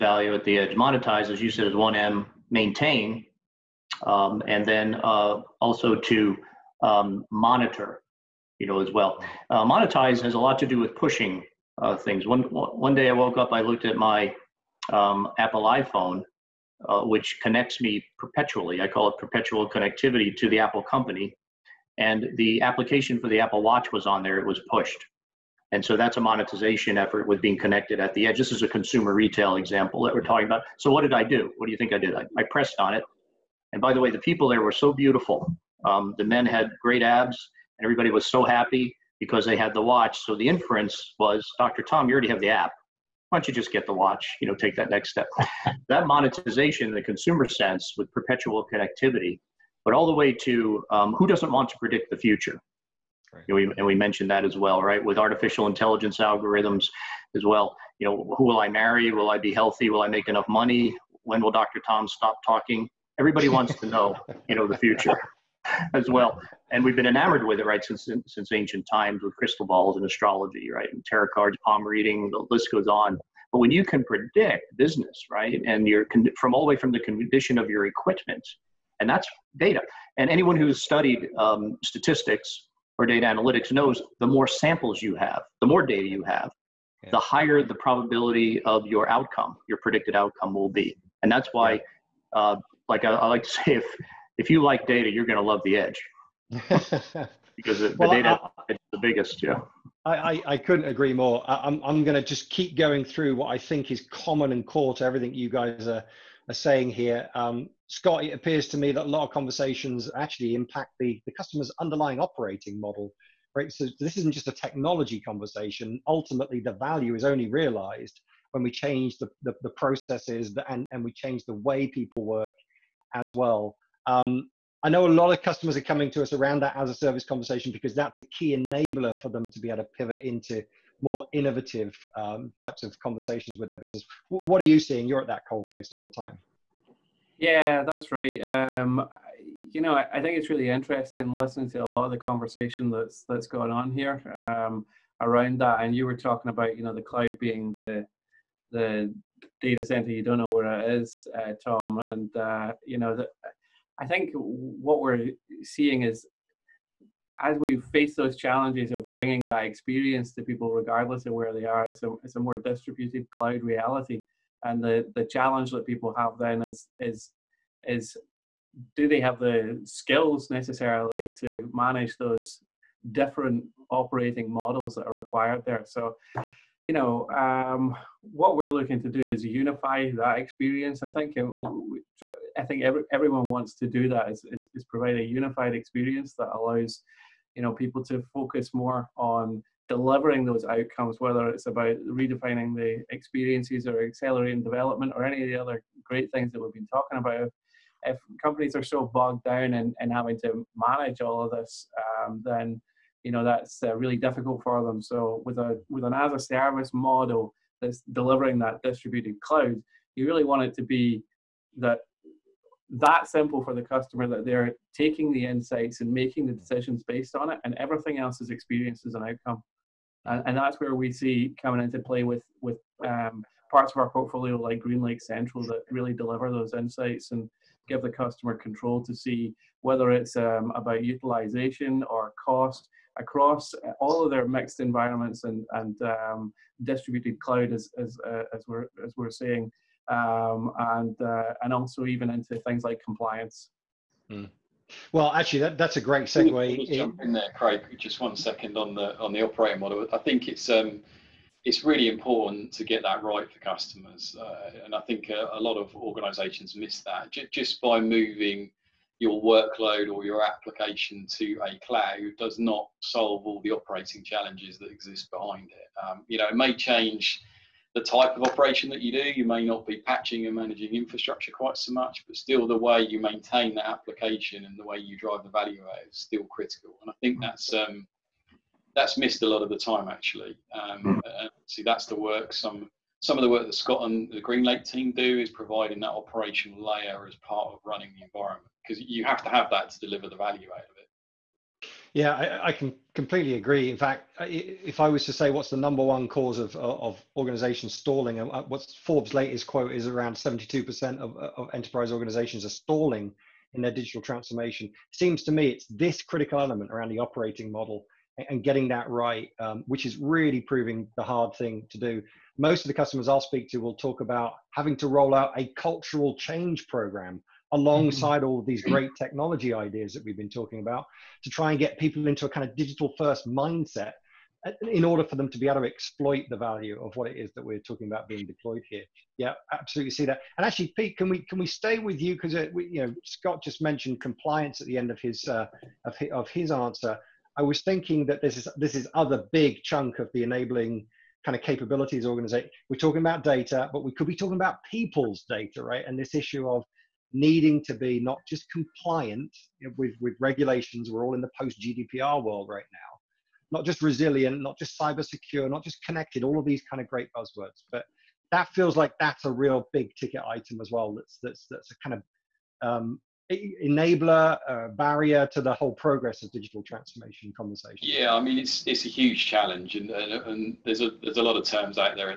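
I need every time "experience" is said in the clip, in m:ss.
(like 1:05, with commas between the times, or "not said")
2:39, 3:00, 3:05, 3:13, 3:38.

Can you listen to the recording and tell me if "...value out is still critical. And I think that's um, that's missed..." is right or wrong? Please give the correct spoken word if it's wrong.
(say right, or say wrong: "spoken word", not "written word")
right.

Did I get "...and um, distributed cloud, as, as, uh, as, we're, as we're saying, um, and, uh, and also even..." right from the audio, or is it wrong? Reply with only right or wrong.
right.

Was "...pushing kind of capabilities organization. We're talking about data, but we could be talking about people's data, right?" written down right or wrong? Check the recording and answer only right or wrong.
wrong.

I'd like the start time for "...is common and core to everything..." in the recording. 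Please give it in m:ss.
1:43.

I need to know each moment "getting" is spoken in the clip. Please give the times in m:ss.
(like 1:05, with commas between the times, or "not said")
5:08.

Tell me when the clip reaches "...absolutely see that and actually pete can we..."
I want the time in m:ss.
5:29.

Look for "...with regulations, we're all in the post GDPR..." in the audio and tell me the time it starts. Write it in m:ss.
5:50.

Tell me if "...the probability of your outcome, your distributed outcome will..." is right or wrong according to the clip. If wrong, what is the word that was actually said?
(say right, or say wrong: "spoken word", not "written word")
wrong: "predicted", not "distributed".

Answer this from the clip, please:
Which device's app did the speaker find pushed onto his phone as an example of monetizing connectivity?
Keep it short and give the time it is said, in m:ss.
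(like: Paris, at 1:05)
Apple Watch, at 0:23.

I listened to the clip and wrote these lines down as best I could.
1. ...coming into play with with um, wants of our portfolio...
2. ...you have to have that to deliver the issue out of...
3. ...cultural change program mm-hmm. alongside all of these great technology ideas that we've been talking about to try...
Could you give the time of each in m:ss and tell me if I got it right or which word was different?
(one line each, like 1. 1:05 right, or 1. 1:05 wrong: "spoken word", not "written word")
1. 3:41 wrong: "parts", not "wants"
2. 4:49 wrong: "value", not "issue"
3. 5:15 right.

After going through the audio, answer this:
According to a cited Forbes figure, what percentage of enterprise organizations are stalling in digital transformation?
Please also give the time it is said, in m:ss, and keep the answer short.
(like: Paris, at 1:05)
72%, at 5:00.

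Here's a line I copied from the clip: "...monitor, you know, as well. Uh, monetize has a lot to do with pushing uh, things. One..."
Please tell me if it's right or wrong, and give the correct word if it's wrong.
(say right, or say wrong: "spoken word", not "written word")
right.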